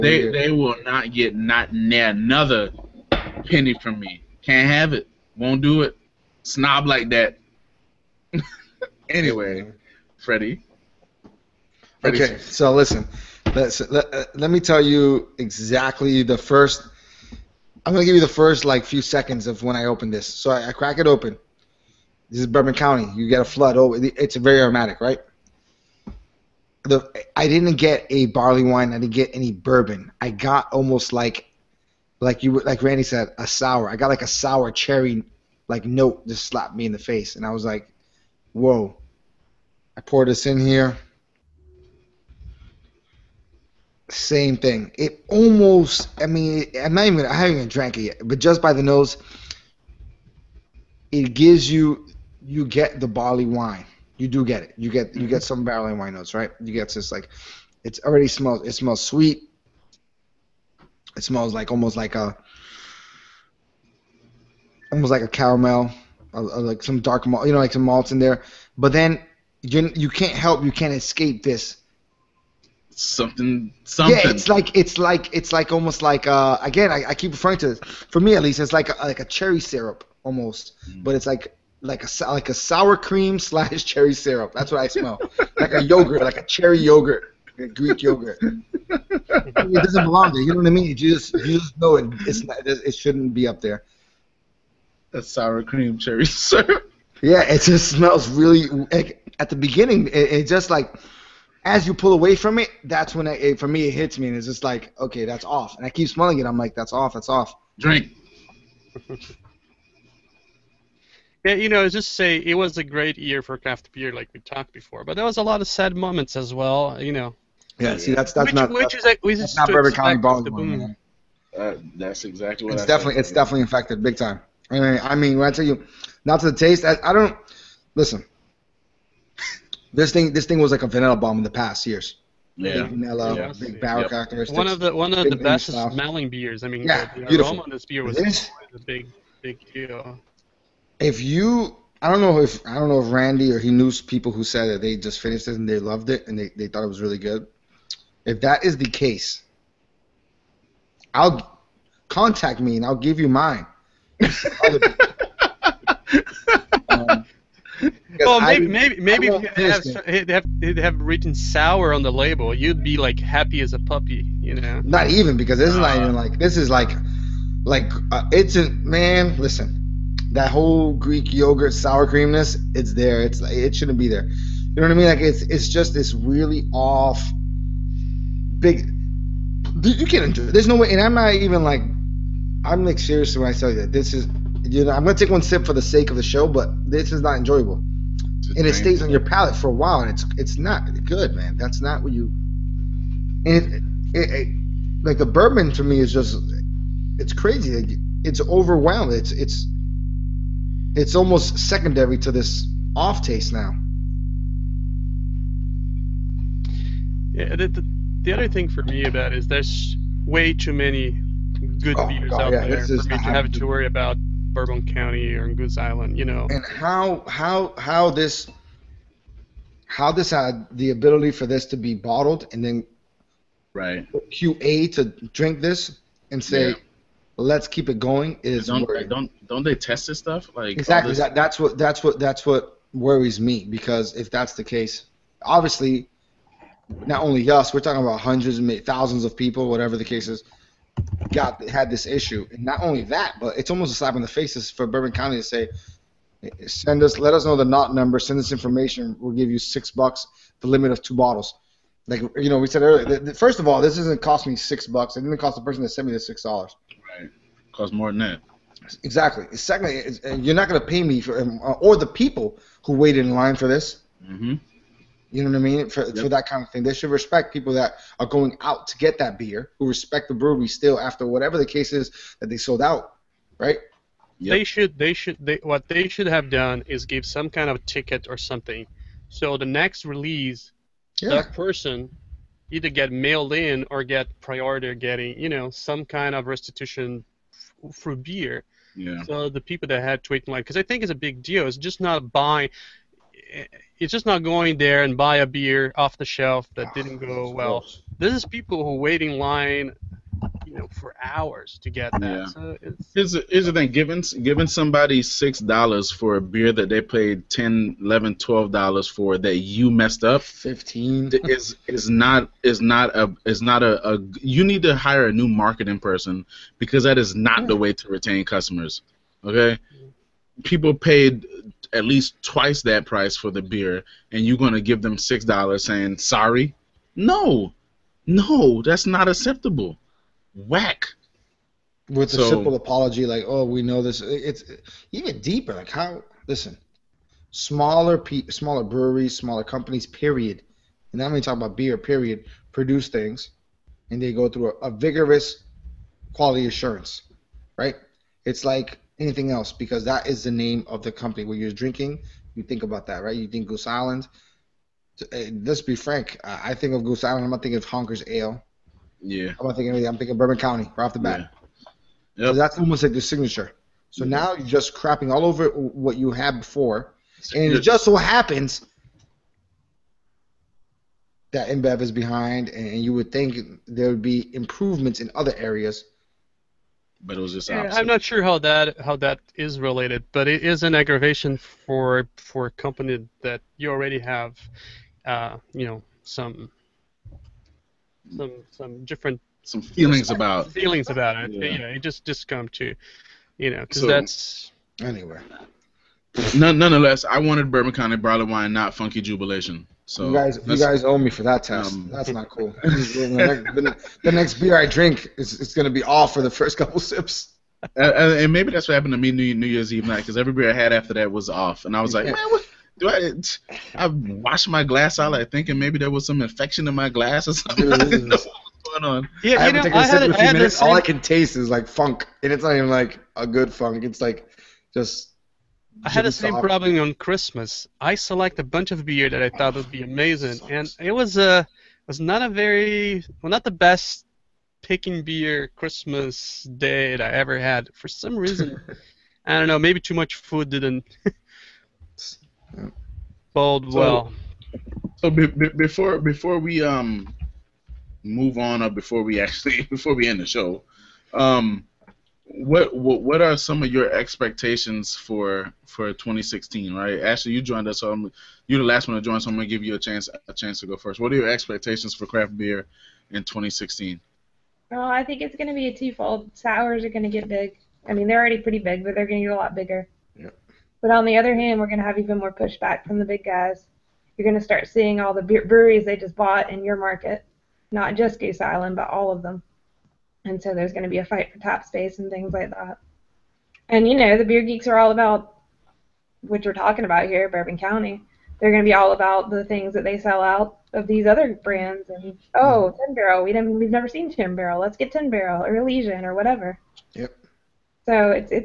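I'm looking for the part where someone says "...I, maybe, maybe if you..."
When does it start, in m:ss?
2:38.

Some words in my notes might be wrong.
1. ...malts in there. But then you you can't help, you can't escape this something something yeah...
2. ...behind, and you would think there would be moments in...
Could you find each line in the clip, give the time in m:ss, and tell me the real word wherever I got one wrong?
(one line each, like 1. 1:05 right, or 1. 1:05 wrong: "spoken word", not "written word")
1. 1:07 right
2. 6:12 wrong: "improvements", not "moments".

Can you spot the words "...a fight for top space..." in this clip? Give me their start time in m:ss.
8:01.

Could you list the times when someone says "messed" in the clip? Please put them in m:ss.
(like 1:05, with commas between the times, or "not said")
5:09.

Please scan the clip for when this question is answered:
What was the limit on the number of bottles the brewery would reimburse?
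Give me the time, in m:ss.
4:11.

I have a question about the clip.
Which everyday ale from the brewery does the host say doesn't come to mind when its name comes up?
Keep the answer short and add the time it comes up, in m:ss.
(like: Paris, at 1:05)
Honker's Ale, at 5:57.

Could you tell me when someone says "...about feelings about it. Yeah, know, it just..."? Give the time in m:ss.
6:30.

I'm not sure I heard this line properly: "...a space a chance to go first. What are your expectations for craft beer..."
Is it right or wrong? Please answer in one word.
wrong.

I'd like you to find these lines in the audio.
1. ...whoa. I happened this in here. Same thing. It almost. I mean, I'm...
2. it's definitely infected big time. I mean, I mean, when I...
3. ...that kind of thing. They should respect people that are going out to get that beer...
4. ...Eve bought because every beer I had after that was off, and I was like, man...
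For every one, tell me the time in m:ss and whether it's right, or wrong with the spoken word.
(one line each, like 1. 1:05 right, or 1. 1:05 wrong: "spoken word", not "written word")
1. 0:38 wrong: "poured", not "happened"
2. 2:03 right
3. 4:26 right
4. 6:49 wrong: "night", not "bought".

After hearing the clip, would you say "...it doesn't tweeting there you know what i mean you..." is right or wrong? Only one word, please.
wrong.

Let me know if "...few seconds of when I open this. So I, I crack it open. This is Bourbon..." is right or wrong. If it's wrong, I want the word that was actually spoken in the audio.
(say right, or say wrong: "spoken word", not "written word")
right.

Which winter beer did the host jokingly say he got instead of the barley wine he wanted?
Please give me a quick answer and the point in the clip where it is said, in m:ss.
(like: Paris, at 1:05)
Funky Jubilation, at 6:38.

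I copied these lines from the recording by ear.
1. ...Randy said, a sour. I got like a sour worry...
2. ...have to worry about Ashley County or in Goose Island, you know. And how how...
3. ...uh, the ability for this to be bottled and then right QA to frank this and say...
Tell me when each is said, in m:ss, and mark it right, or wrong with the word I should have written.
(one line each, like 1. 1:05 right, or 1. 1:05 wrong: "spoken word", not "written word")
1. 0:32 wrong: "cherry", not "worry"
2. 3:33 wrong: "Bourbon", not "Ashley"
3. 3:40 wrong: "drink", not "frank".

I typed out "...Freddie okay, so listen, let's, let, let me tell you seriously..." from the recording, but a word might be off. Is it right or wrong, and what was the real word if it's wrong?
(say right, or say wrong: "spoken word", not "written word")
wrong: "exactly", not "seriously".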